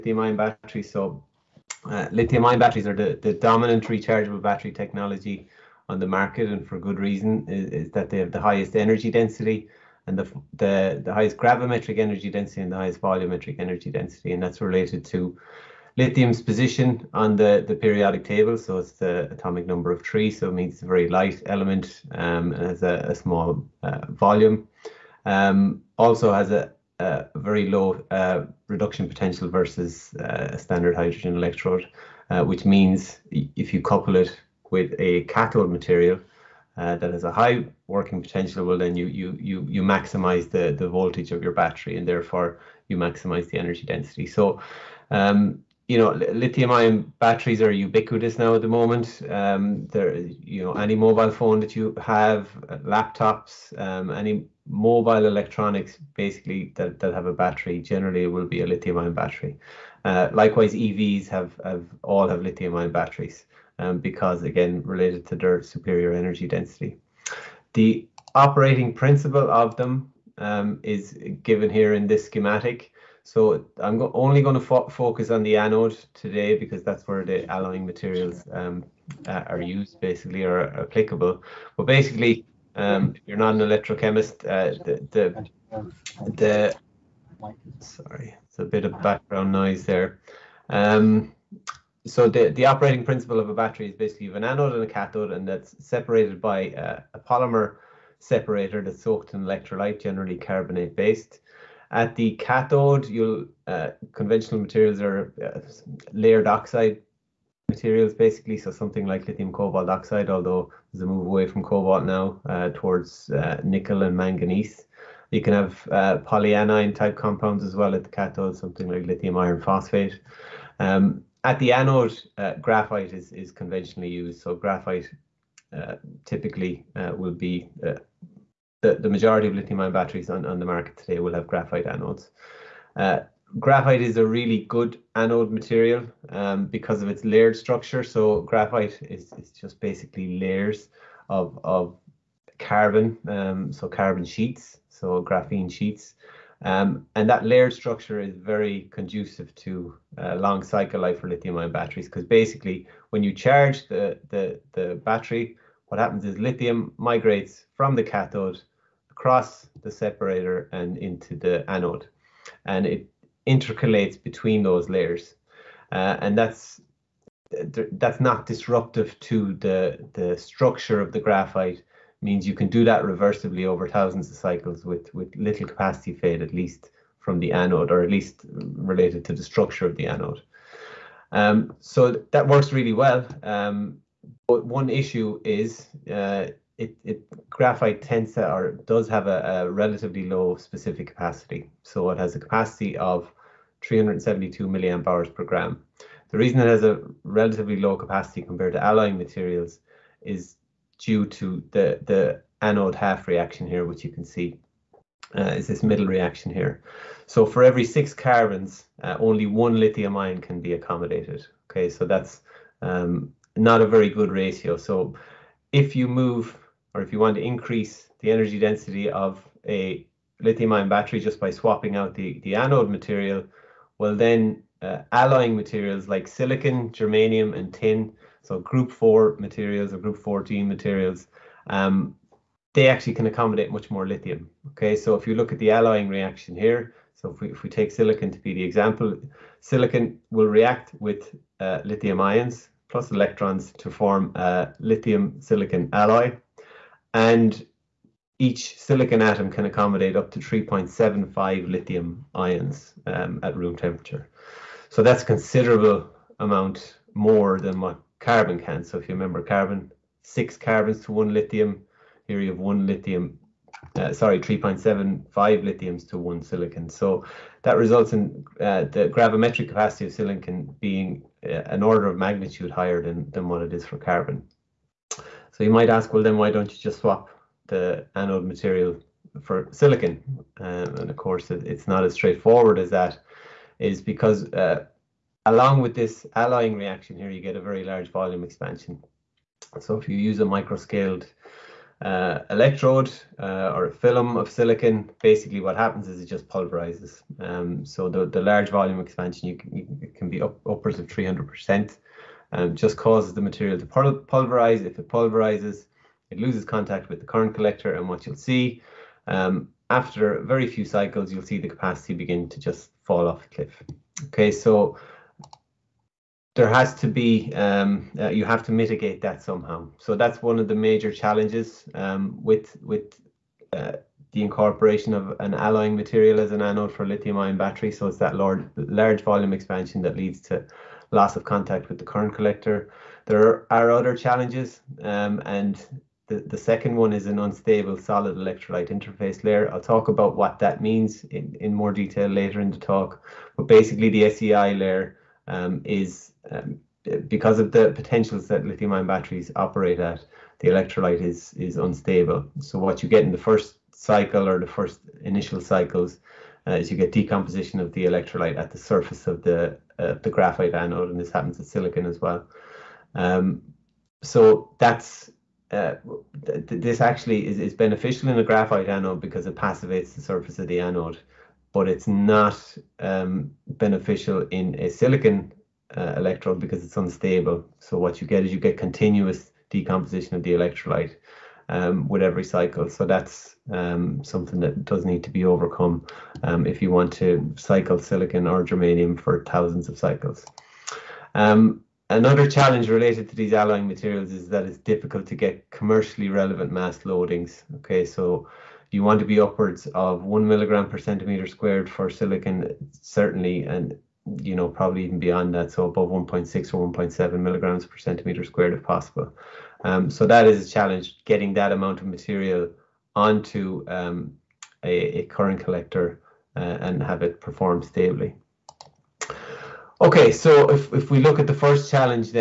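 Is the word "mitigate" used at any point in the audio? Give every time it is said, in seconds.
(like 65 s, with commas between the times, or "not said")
318 s.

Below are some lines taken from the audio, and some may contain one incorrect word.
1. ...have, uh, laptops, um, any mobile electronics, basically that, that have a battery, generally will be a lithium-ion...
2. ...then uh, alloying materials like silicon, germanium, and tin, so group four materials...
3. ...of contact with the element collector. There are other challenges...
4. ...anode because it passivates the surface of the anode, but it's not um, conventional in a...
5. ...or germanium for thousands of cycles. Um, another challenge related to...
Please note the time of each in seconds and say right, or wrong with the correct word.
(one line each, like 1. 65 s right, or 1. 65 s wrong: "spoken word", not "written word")
1. 52 s right
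2. 224 s right
3. 331 s wrong: "current", not "element"
4. 368 s wrong: "beneficial", not "conventional"
5. 388 s right.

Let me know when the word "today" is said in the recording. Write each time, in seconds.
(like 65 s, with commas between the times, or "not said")
76 s, 130 s.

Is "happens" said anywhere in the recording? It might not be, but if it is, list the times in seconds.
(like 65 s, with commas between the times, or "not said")
156 s, 295 s, 361 s.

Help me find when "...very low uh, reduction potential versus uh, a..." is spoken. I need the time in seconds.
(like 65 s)
27 s.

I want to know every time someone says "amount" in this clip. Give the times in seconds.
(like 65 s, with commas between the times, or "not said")
256 s, 411 s.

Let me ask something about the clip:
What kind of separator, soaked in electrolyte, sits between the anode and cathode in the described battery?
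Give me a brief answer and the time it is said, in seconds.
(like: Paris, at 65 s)
polymer separator, at 97 s.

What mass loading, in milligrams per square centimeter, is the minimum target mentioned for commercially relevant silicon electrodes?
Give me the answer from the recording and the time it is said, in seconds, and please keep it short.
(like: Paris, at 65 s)
1, at 400 s.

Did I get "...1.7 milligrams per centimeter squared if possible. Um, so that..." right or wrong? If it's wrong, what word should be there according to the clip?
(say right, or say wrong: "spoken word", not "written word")
right.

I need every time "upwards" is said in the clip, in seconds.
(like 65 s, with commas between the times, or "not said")
300 s, 399 s.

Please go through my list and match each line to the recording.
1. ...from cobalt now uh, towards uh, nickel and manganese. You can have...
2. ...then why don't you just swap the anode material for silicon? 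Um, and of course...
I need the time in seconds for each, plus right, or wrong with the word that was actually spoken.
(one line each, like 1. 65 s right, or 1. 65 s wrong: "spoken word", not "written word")
1. 111 s right
2. 276 s right.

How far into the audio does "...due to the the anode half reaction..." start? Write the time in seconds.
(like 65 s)
200 s.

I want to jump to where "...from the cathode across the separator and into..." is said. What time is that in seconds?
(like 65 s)
157 s.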